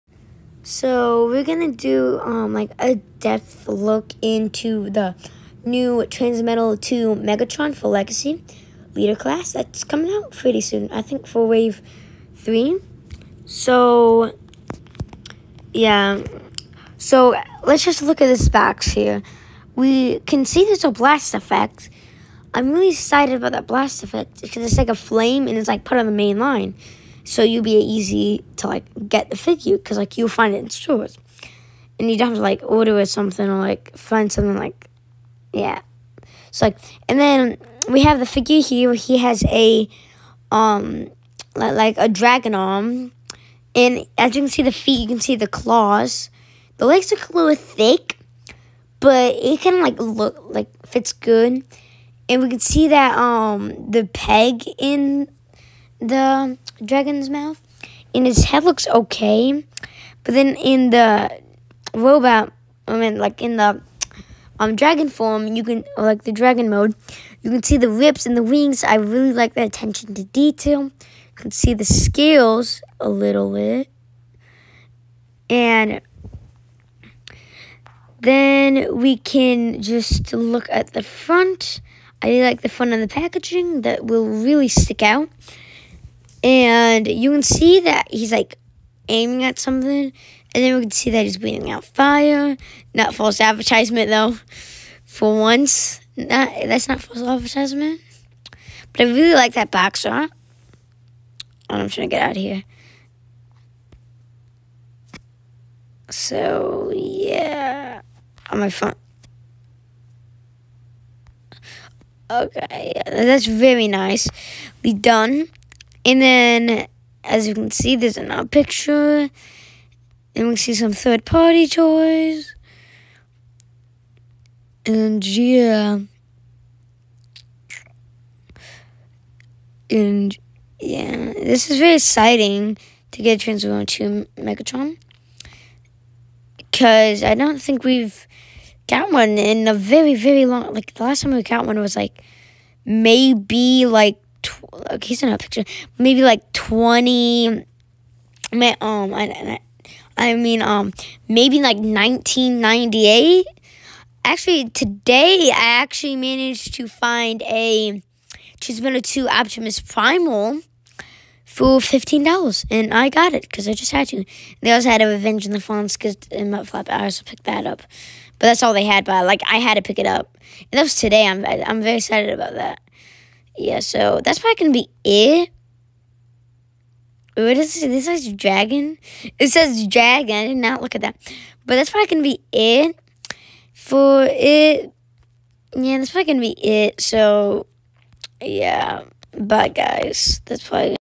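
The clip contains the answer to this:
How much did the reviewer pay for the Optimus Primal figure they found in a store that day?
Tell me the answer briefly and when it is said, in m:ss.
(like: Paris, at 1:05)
$15, at 2:41.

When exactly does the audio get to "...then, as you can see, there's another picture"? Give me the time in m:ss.
1:56.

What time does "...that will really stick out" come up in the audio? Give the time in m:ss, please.
1:23.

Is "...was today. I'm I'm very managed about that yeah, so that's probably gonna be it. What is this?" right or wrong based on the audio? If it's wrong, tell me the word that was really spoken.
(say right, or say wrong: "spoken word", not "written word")
wrong: "excited", not "managed".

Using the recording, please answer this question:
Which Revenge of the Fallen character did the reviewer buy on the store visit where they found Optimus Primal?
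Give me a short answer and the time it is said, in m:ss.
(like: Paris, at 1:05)
Mudflap, at 2:46.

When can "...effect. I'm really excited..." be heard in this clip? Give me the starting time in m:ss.
0:21.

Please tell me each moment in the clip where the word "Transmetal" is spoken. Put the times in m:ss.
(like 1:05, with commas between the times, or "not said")
0:06, 2:13.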